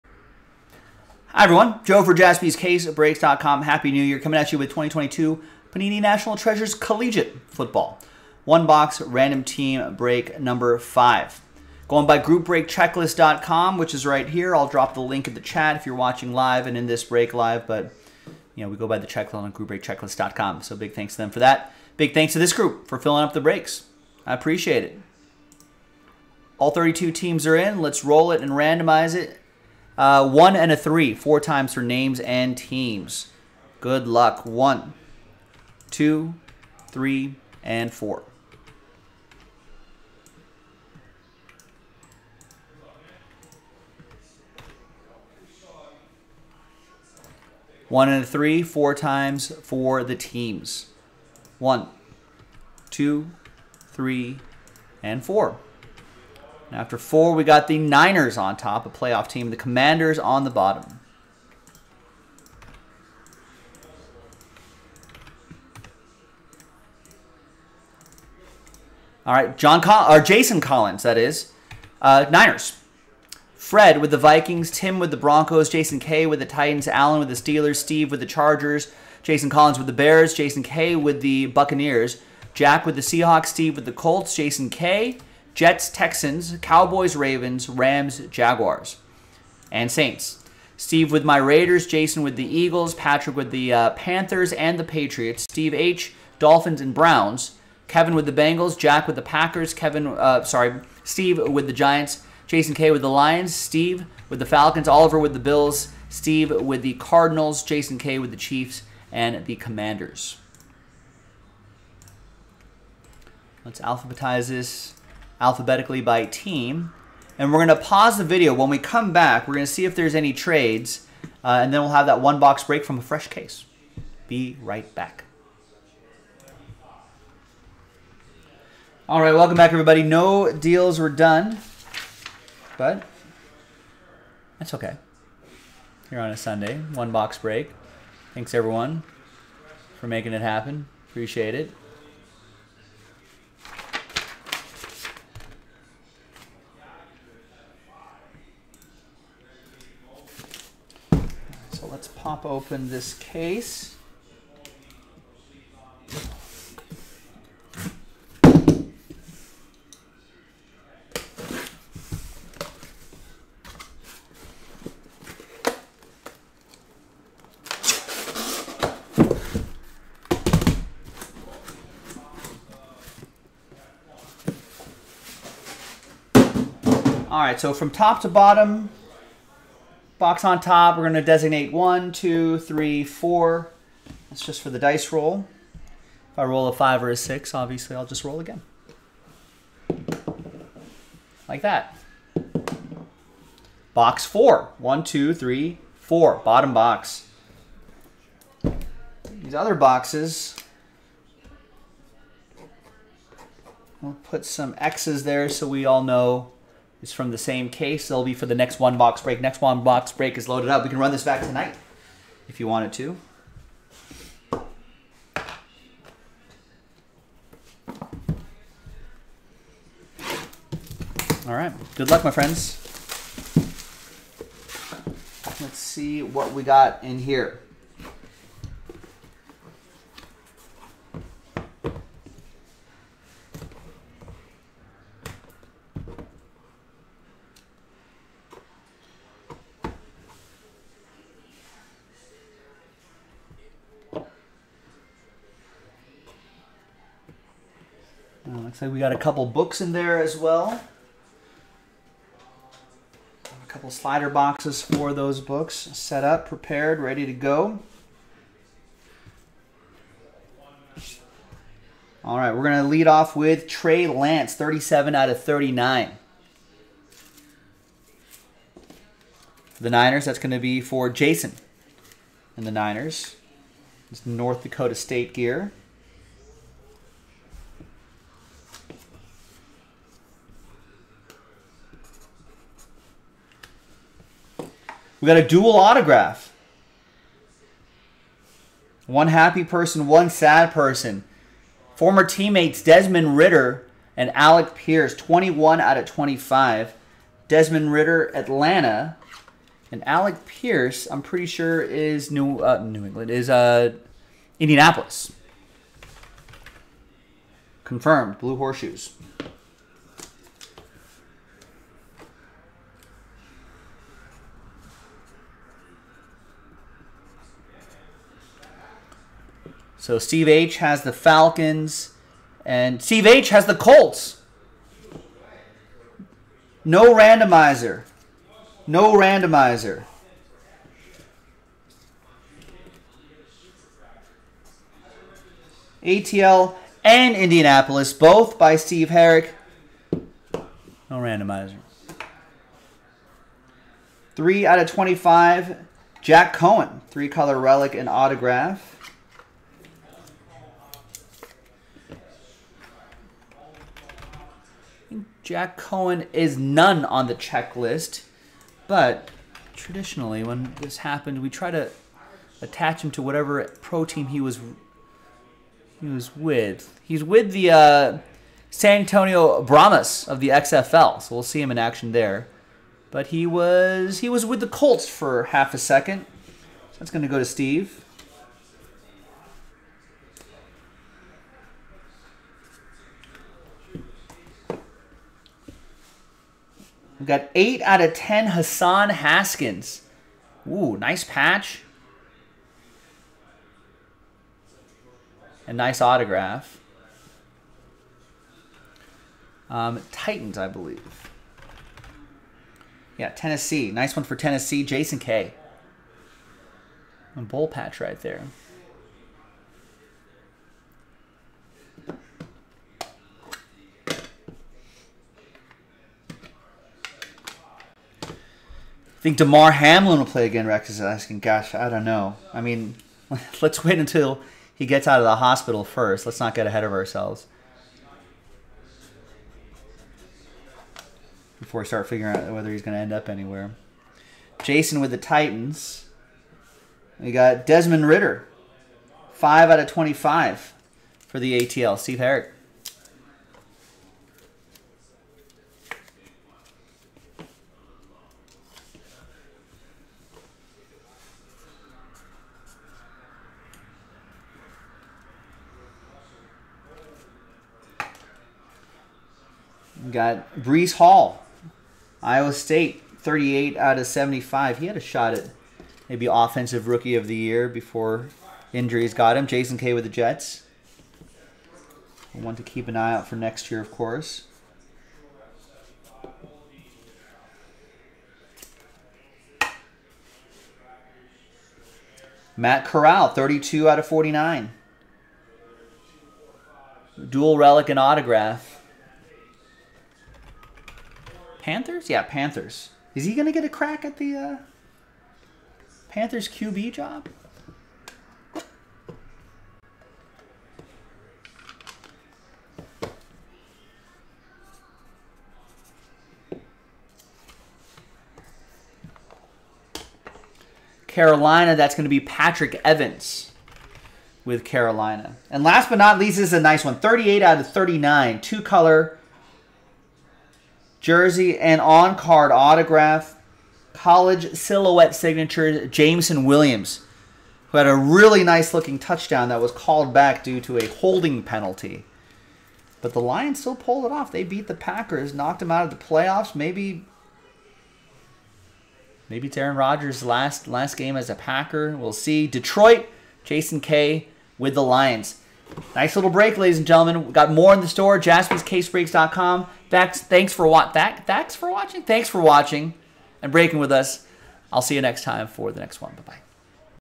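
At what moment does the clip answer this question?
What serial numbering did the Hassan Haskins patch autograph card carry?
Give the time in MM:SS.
06:27.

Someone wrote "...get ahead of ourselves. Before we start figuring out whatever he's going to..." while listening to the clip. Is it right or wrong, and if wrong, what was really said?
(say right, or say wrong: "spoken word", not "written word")
wrong: "whether", not "whatever".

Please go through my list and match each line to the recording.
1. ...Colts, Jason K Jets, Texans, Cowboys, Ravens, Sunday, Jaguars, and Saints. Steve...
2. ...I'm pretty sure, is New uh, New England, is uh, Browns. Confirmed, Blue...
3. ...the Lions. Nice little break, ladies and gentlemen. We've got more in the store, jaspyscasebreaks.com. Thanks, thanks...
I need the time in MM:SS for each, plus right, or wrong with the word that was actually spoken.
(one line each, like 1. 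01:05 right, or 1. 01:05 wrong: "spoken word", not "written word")
1. 01:23 wrong: "Rams", not "Sunday"
2. 05:01 wrong: "Indianapolis", not "Browns"
3. 09:04 right.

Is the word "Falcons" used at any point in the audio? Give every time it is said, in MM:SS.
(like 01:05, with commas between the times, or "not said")
01:44, 05:21.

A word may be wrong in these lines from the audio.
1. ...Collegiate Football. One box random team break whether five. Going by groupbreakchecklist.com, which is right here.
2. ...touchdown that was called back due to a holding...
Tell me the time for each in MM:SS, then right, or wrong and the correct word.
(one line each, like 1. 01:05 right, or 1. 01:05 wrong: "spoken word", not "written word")
1. 00:06 wrong: "number", not "whether"
2. 08:48 right.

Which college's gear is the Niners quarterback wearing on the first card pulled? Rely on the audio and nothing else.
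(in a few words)
North Dakota State.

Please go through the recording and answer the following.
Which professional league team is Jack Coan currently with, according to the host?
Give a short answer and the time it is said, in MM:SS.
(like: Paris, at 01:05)
San Antonio Brahmas, at 06:08.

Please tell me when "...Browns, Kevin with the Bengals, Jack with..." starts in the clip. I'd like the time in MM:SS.
01:36.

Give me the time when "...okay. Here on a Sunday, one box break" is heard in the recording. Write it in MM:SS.
02:14.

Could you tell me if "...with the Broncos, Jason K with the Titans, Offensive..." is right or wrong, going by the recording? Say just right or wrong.
wrong.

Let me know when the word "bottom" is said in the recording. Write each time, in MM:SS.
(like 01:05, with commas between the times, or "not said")
01:00, 02:58, 03:16.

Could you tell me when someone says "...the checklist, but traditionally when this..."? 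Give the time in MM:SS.
05:57.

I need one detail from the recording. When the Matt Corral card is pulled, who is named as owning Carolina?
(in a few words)
Patrick Evans.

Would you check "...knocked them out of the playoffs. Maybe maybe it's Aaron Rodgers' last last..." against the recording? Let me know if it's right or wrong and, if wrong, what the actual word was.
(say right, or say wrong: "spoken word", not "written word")
right.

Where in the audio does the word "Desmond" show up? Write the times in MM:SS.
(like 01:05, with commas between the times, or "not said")
04:52, 04:57, 07:17.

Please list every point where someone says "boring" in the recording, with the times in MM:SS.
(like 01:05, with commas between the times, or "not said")
not said.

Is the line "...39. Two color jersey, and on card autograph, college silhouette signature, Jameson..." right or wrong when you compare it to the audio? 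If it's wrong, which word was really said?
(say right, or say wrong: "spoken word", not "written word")
right.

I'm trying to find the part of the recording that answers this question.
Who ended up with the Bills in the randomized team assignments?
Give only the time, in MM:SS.
01:44.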